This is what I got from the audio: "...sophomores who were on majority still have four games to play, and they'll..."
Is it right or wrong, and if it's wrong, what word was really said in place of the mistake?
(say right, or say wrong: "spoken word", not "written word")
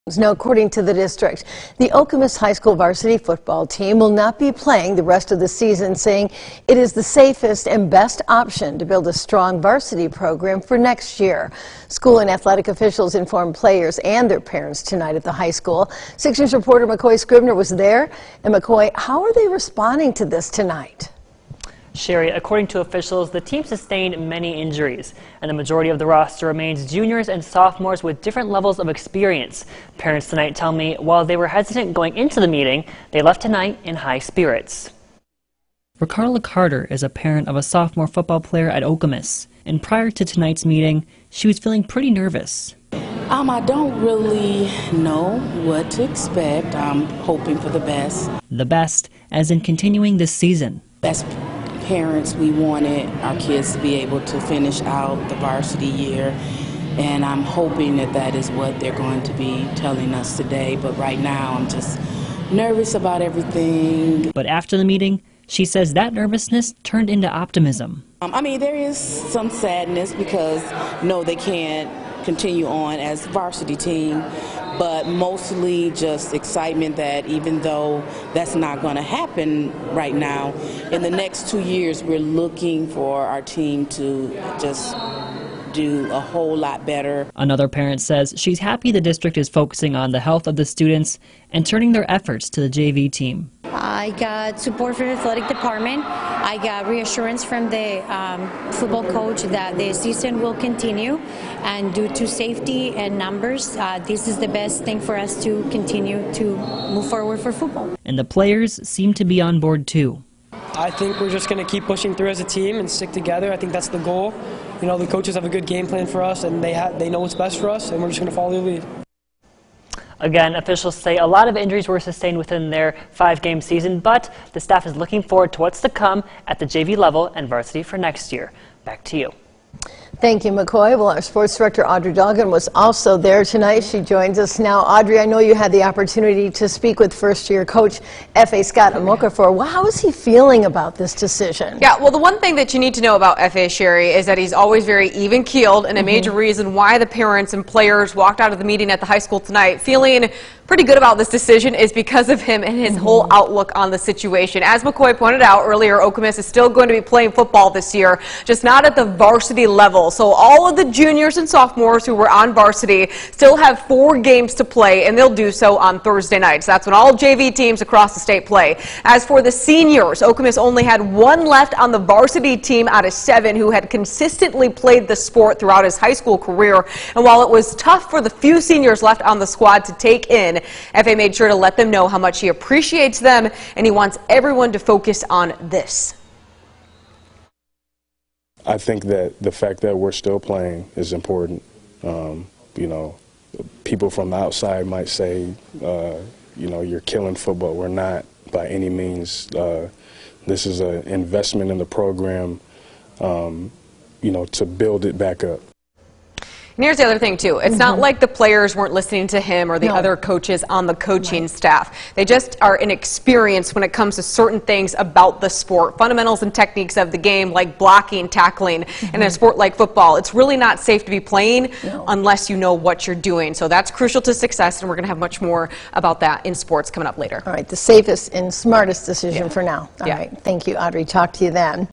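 wrong: "varsity", not "majority".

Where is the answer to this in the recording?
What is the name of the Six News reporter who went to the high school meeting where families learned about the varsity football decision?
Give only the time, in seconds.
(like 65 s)
16 s.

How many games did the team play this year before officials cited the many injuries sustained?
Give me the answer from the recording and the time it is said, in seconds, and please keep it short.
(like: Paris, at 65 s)
5, at 123 s.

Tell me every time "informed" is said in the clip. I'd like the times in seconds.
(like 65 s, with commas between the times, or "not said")
13 s.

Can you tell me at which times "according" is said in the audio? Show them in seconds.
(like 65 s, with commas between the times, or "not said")
0 s, 22 s.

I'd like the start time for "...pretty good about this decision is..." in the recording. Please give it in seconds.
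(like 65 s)
150 s.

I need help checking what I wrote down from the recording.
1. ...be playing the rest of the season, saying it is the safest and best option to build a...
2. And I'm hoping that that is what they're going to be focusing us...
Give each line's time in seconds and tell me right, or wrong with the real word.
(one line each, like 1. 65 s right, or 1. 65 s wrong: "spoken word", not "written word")
1. 4 s right
2. 56 s wrong: "telling", not "focusing".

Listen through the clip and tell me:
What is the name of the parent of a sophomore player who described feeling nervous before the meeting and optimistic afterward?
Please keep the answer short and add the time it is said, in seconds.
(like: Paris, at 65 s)
Ricarla Carter, at 35 s.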